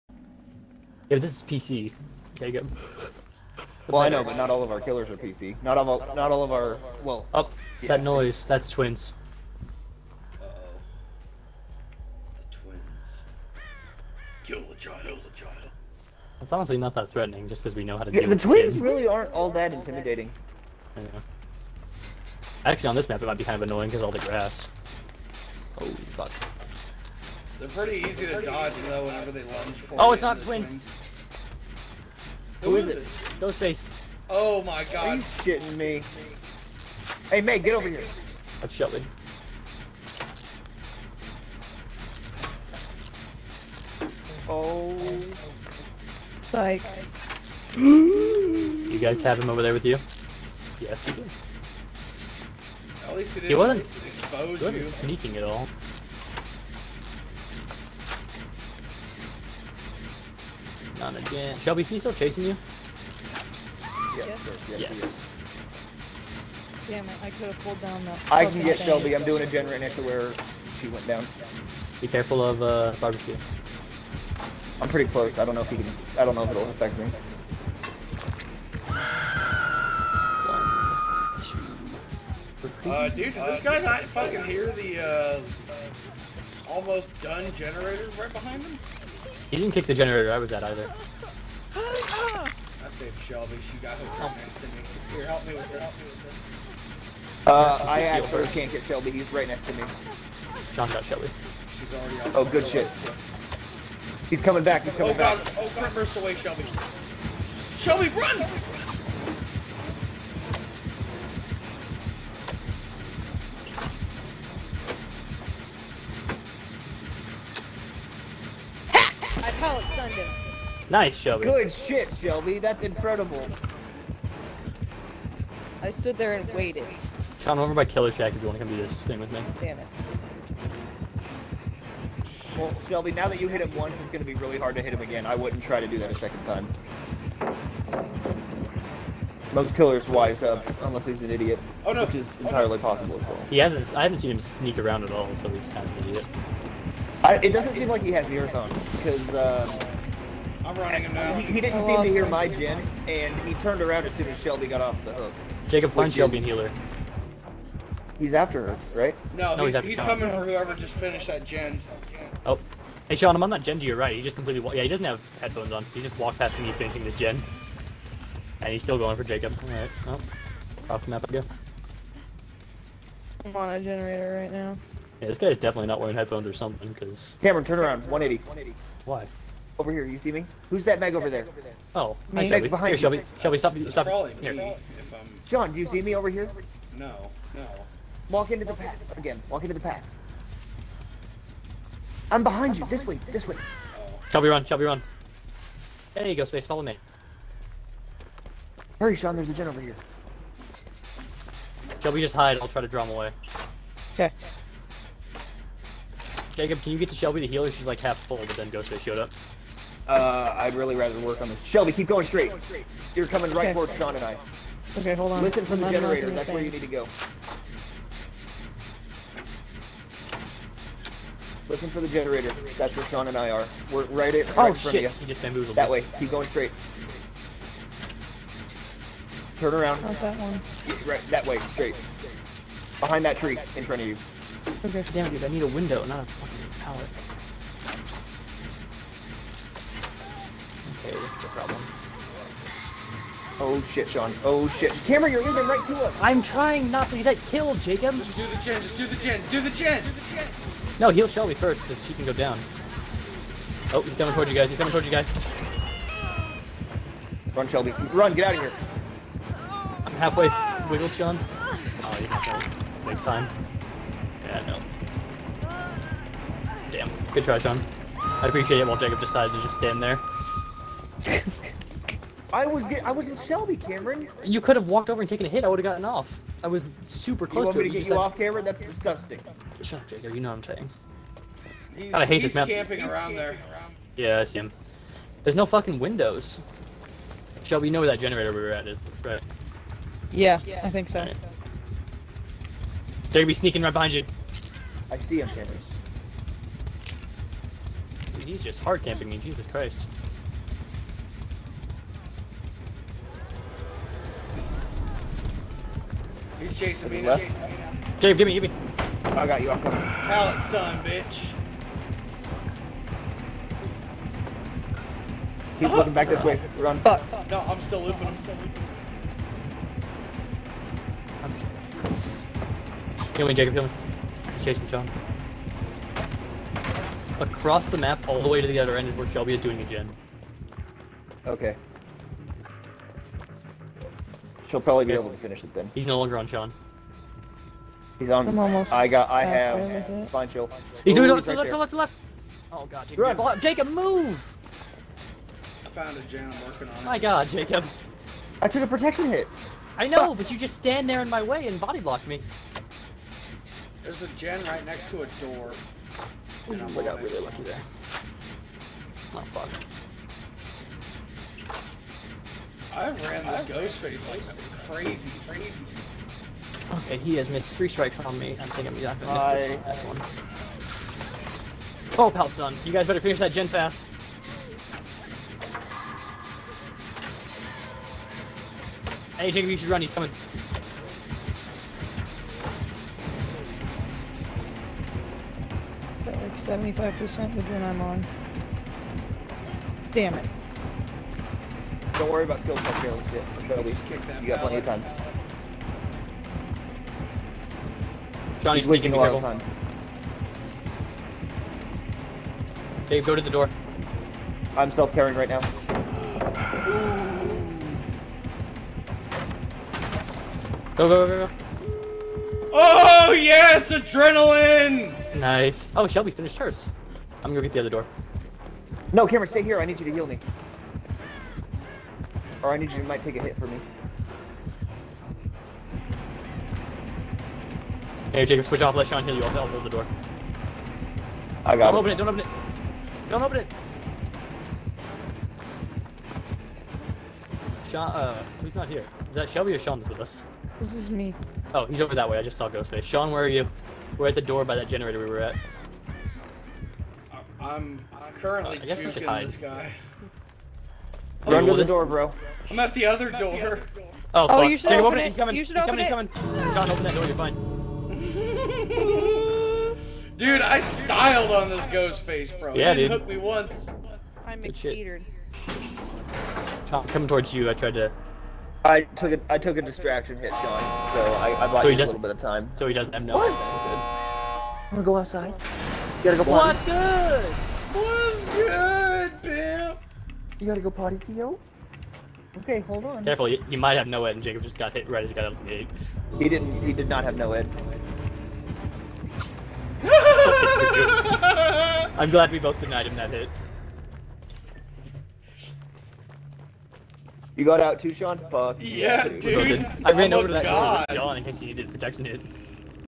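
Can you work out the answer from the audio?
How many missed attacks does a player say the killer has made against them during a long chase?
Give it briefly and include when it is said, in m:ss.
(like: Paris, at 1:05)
3, at 6:07.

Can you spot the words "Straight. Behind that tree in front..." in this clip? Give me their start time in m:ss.
3:51.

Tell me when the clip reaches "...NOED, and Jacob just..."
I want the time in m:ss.
8:04.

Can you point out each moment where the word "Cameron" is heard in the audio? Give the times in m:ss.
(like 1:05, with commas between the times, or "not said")
2:57, 4:05, 4:33, 4:38, 4:55, 6:59.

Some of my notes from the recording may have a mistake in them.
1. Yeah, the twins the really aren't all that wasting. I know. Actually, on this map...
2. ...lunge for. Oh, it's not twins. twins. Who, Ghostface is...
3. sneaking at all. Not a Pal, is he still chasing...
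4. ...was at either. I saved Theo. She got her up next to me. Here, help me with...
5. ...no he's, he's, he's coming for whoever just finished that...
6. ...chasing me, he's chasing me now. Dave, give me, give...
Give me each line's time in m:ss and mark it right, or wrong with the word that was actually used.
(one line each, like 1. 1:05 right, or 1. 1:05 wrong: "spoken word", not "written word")
1. 0:18 wrong: "intimidating", not "wasting"
2. 0:29 wrong: "Who", not "Ghostface"
3. 0:54 wrong: "Shelby", not "Pal"
4. 1:30 wrong: "Shelby", not "Theo"
5. 2:39 right
6. 5:06 right.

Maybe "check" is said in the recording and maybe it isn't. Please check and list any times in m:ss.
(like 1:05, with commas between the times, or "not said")
6:32.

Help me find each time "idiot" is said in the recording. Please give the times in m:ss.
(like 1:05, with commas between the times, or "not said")
2:21, 2:26.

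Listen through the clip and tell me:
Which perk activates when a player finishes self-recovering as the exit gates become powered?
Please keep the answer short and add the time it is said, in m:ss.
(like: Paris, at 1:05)
Adrenaline, at 6:53.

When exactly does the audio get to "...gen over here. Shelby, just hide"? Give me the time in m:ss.
3:19.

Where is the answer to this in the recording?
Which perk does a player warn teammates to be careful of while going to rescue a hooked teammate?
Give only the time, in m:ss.
1:13.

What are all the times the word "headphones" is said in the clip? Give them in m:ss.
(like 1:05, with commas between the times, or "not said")
2:45, 2:56.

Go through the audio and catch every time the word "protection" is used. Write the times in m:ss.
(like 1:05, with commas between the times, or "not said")
5:48, 8:21.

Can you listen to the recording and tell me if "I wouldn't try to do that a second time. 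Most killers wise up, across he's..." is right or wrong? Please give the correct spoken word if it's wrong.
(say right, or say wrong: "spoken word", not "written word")
wrong: "unless", not "across".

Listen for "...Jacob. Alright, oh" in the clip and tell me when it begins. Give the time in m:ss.
2:49.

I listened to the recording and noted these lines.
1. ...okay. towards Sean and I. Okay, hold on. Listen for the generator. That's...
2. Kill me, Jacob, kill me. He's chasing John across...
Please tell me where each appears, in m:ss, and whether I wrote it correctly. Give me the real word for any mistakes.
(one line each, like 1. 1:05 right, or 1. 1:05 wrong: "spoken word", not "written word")
1. 3:33 right
2. 5:23 right.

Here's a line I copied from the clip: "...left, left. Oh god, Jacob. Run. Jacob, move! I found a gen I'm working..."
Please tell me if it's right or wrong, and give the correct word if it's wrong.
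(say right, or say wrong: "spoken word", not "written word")
right.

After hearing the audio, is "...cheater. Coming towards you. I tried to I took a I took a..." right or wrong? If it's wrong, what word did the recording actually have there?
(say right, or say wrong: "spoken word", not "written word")
right.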